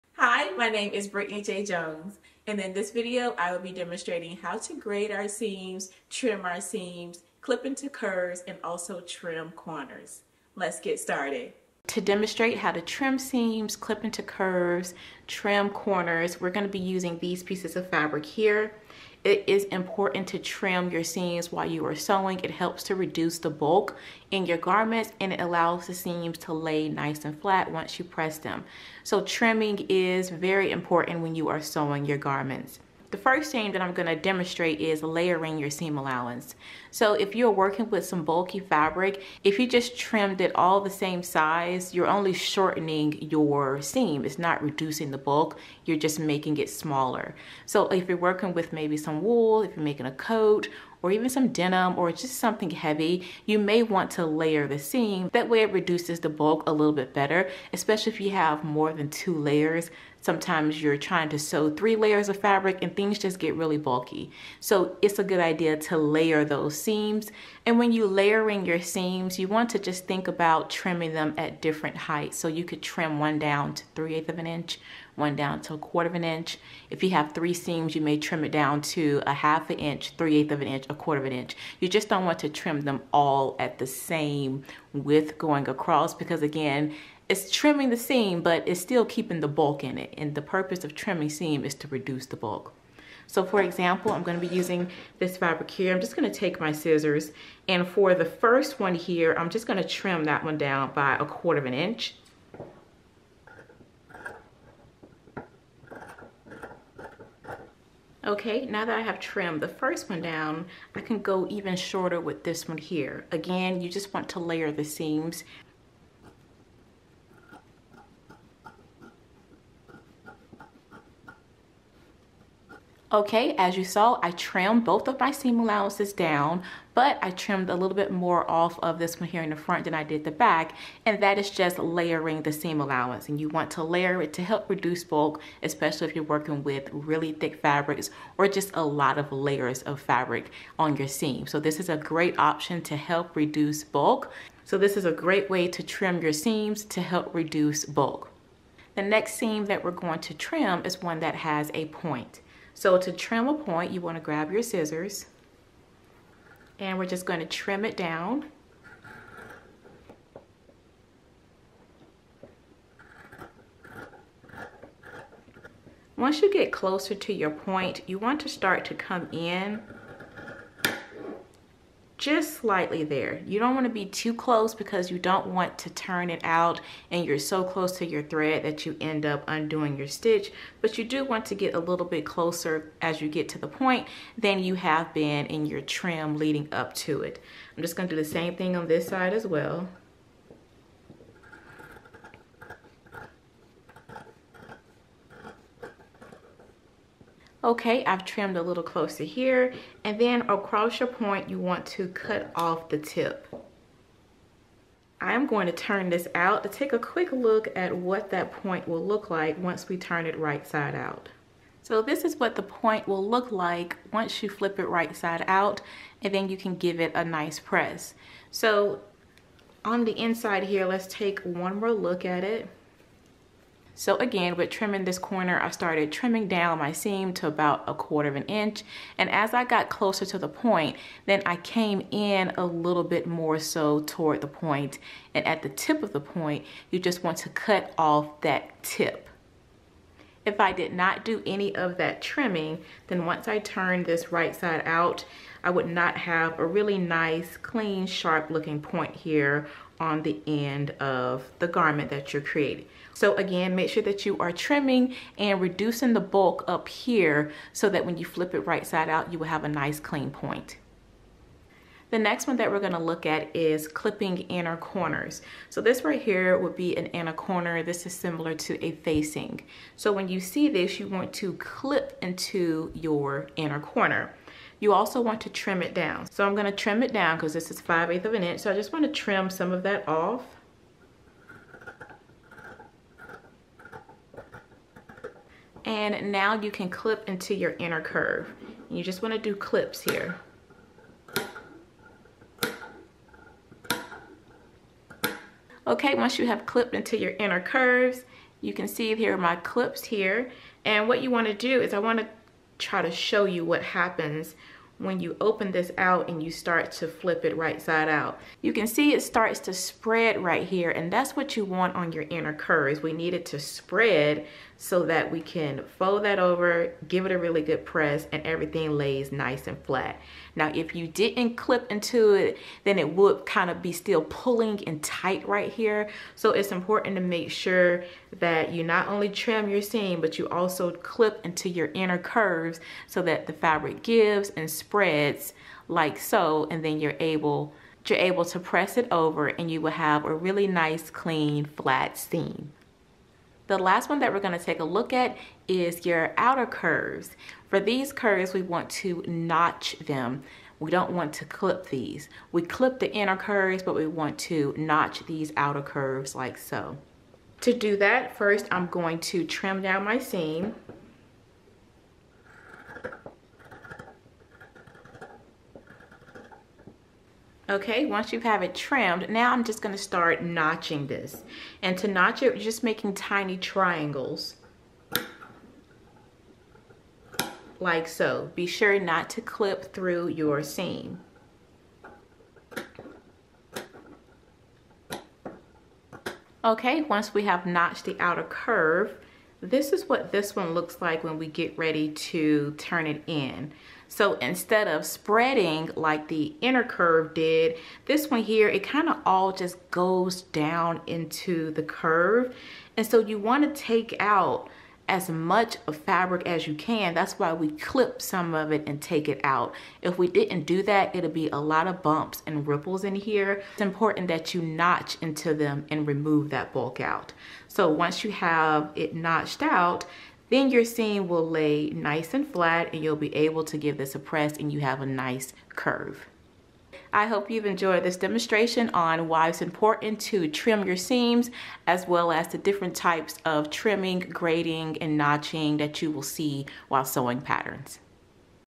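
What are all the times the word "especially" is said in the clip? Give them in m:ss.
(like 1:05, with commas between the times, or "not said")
0:57, 2:15.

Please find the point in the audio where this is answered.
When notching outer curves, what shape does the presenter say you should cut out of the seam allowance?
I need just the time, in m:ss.
6:13.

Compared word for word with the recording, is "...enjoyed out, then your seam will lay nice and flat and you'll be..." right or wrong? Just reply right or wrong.
wrong.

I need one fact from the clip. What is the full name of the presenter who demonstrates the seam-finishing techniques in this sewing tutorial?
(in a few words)
Brittany J. Jones.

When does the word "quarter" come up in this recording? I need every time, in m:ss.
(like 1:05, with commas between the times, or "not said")
1:15, 1:20, 1:41, 3:47.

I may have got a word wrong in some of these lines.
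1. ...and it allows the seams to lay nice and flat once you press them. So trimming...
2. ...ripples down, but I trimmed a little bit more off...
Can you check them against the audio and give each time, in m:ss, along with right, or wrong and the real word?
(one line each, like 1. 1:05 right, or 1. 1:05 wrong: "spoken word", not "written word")
1. 0:25 right
2. 2:05 wrong: "allowances", not "ripples".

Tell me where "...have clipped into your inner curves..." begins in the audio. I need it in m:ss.
4:56.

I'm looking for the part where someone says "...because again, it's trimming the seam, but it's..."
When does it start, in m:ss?
1:26.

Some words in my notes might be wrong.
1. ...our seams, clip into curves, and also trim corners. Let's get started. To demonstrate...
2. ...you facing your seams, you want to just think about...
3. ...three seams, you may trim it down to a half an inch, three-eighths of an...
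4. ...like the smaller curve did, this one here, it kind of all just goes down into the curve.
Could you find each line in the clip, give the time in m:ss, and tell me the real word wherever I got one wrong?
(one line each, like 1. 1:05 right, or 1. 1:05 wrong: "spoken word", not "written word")
1. 0:06 right
2. 1:07 wrong: "layering", not "facing"
3. 1:17 right
4. 6:35 wrong: "inner", not "smaller".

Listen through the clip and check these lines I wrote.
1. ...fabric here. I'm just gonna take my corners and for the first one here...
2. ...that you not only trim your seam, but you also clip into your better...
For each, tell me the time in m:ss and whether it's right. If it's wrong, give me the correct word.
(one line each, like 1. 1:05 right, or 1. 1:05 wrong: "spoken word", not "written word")
1. 1:35 wrong: "scissors", not "corners"
2. 5:28 wrong: "inner", not "better".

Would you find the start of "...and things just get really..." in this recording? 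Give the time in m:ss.
1:02.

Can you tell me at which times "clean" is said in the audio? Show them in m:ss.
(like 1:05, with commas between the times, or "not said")
4:07, 4:19, 5:41.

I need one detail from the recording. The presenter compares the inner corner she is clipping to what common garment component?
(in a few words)
a facing.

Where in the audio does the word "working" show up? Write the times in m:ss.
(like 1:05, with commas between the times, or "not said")
0:37, 0:48, 2:16.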